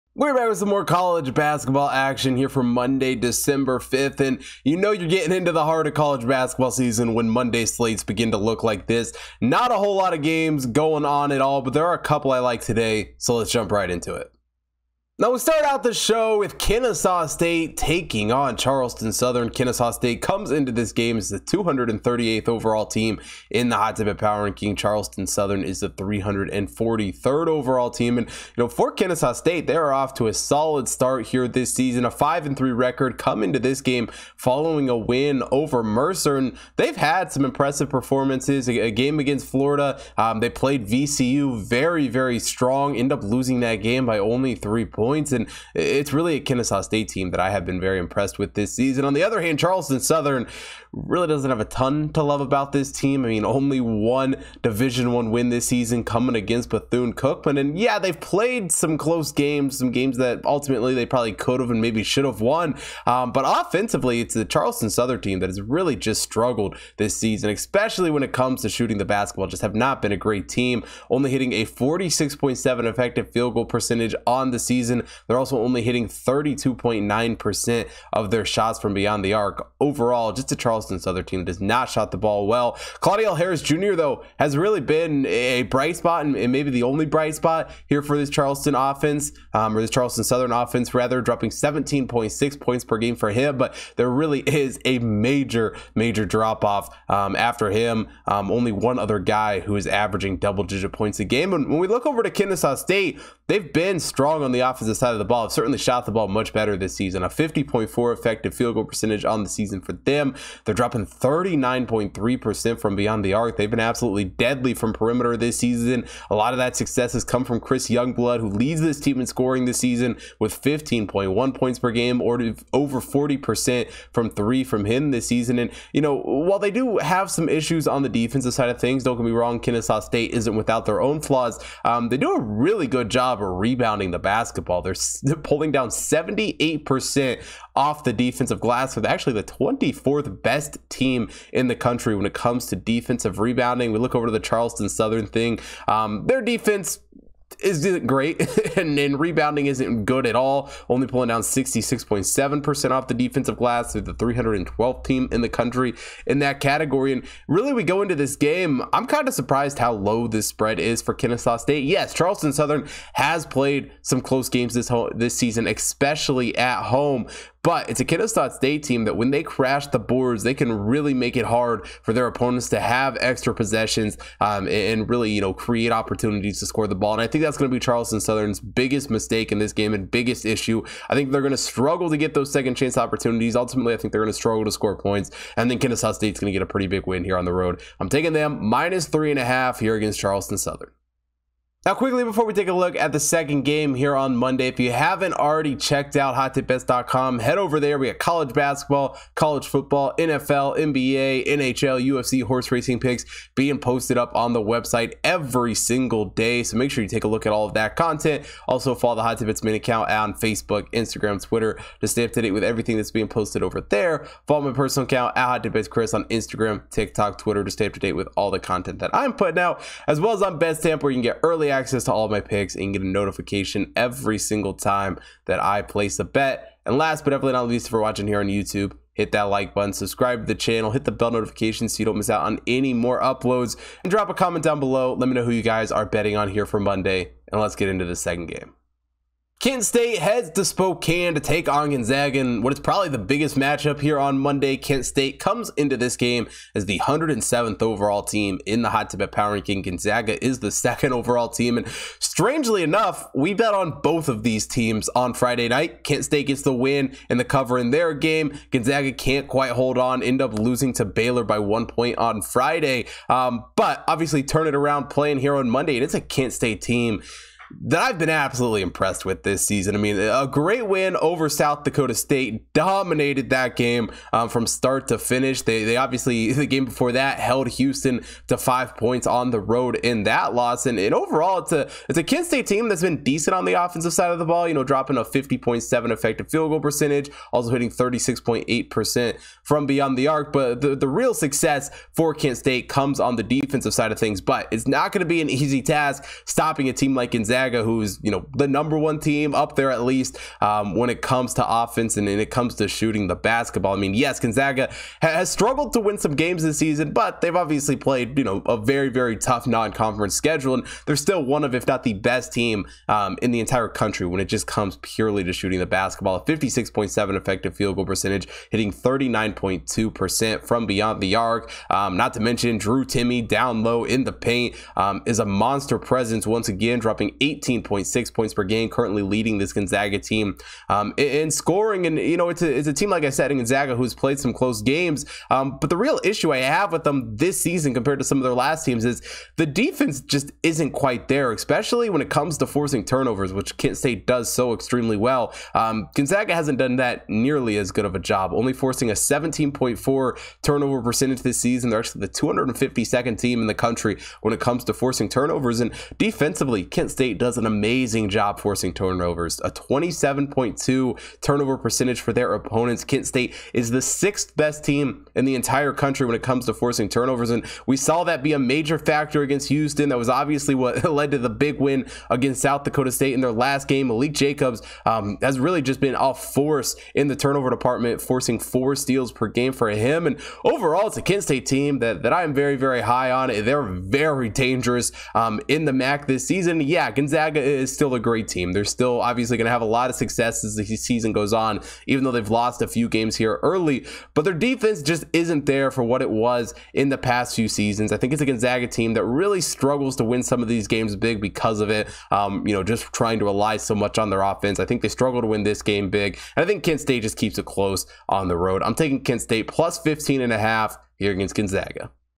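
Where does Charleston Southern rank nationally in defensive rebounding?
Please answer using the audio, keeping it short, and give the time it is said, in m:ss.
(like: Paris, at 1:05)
312th, at 2:34.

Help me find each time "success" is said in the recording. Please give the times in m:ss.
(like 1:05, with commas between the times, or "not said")
1:56, 4:51, 6:30.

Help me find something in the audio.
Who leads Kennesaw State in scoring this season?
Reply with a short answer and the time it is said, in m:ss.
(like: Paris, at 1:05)
Chris Youngblood, at 1:57.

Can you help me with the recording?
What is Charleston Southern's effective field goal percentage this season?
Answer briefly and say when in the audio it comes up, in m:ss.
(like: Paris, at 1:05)
46.7, at 1:11.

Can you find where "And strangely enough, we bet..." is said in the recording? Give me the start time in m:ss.
4:11.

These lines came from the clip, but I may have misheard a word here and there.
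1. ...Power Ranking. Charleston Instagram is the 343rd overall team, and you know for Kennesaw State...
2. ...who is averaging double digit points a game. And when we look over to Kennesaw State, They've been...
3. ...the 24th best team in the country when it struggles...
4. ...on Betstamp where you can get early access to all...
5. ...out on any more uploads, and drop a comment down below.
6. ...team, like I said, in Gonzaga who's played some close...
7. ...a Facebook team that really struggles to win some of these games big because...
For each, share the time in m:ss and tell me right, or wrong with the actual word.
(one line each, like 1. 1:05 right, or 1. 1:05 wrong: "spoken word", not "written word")
1. 0:24 wrong: "Southern", not "Instagram"
2. 1:39 right
3. 2:19 wrong: "comes", not "struggles"
4. 3:40 right
5. 3:52 right
6. 5:32 right
7. 6:38 wrong: "Gonzaga", not "Facebook".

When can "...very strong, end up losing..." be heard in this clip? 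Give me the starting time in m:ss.
0:42.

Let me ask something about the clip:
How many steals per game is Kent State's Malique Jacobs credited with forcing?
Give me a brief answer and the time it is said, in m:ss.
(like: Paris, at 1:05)
4, at 6:18.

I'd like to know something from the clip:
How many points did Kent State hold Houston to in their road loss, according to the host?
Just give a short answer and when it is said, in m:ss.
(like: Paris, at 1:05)
5, at 4:38.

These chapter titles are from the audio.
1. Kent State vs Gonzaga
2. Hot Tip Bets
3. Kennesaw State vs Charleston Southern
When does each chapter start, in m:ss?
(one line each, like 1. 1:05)
1. 3:58
2. 3:10
3. 0:14.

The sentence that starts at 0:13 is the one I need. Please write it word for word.
So let's jump right into it.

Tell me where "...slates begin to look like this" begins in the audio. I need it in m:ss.
0:07.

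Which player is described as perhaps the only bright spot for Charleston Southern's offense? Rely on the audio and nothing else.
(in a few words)
Claudell Harris Jr.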